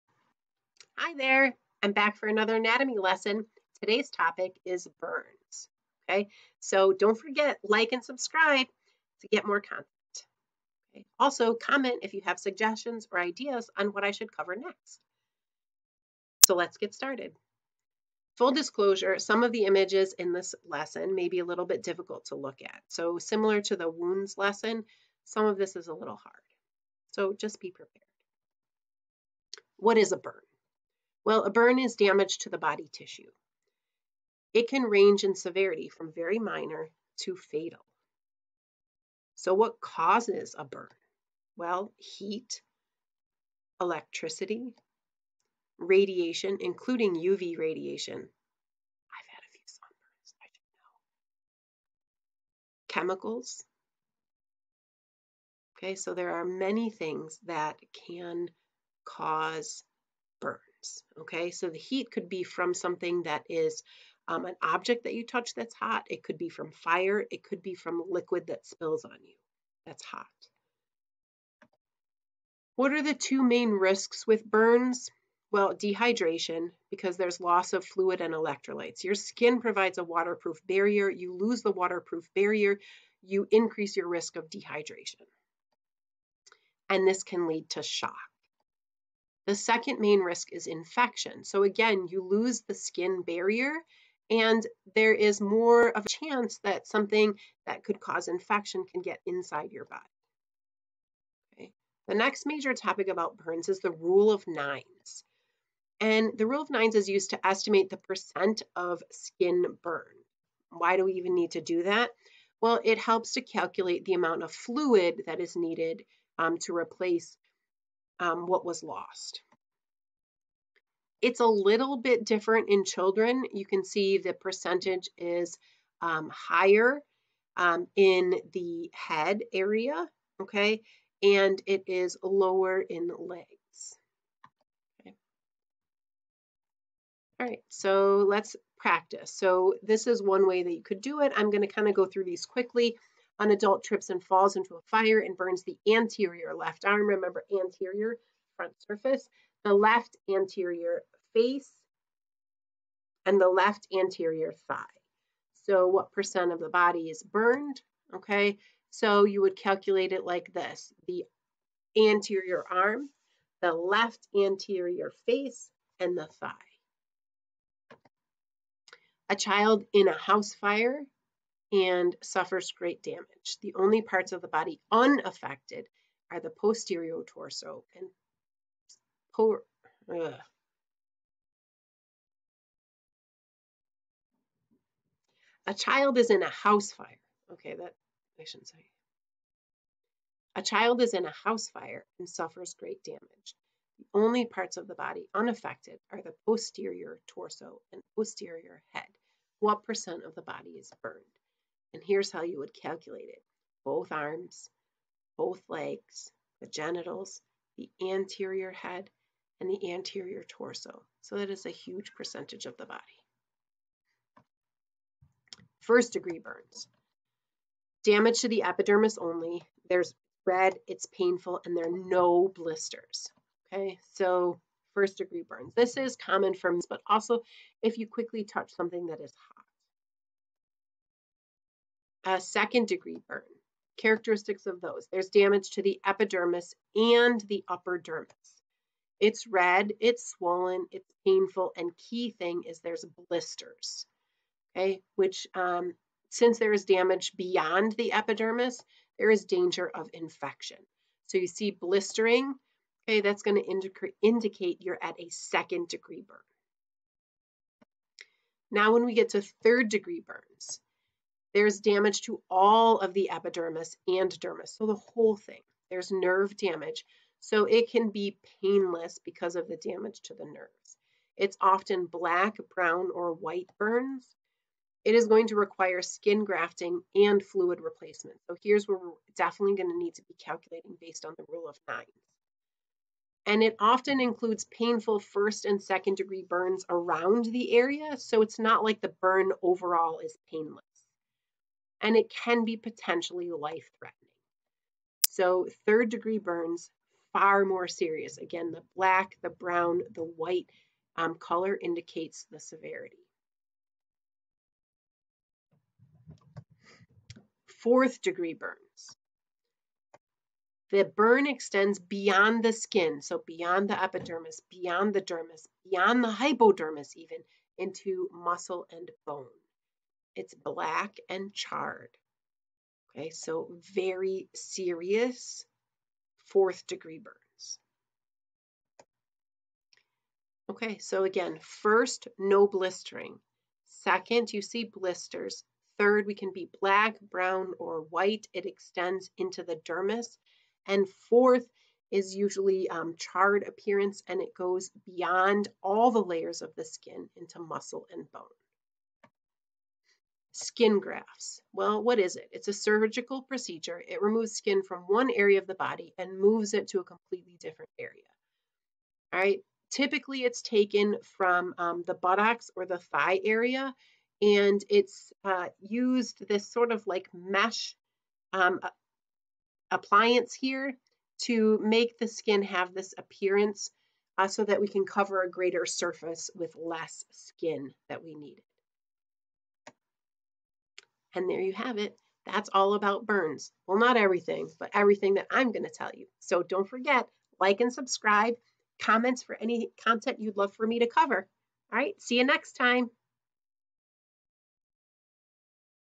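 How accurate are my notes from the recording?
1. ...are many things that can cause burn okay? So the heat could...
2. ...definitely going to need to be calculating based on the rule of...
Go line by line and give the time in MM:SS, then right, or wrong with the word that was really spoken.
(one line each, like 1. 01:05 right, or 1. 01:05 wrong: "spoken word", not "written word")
1. 00:56 right
2. 04:39 right.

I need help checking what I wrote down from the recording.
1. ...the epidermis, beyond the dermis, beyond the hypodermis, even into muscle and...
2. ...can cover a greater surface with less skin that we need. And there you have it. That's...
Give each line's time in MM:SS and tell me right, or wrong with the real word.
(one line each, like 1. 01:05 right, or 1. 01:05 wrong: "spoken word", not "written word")
1. 05:13 right
2. 06:14 right.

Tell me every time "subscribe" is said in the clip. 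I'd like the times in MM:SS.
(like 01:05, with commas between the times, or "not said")
00:08, 06:27.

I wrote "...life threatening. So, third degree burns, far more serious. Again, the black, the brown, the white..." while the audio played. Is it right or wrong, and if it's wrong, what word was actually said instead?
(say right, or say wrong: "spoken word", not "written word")
right.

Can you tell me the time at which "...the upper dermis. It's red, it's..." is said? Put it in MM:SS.
03:57.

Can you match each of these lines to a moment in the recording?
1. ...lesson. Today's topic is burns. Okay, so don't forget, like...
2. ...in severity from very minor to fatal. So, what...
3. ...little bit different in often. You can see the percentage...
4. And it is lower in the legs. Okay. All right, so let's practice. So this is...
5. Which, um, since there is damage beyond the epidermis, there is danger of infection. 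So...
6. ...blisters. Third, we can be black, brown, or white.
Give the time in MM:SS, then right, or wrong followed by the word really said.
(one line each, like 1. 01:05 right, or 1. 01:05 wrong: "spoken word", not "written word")
1. 00:02 right
2. 00:35 right
3. 02:01 wrong: "children", not "often"
4. 02:11 right
5. 04:05 right
6. 05:34 right.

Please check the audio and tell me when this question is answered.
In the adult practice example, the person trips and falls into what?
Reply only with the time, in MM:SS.
02:24.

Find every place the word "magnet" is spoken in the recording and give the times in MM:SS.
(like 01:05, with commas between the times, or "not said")
not said.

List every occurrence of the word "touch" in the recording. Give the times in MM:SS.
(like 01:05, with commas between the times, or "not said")
01:05, 03:48.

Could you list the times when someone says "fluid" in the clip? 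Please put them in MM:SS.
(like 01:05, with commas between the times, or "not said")
01:17, 01:54, 04:37.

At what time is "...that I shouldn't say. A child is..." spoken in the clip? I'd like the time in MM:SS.
03:07.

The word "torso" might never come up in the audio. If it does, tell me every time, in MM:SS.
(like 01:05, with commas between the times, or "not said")
02:57, 03:17, 03:30.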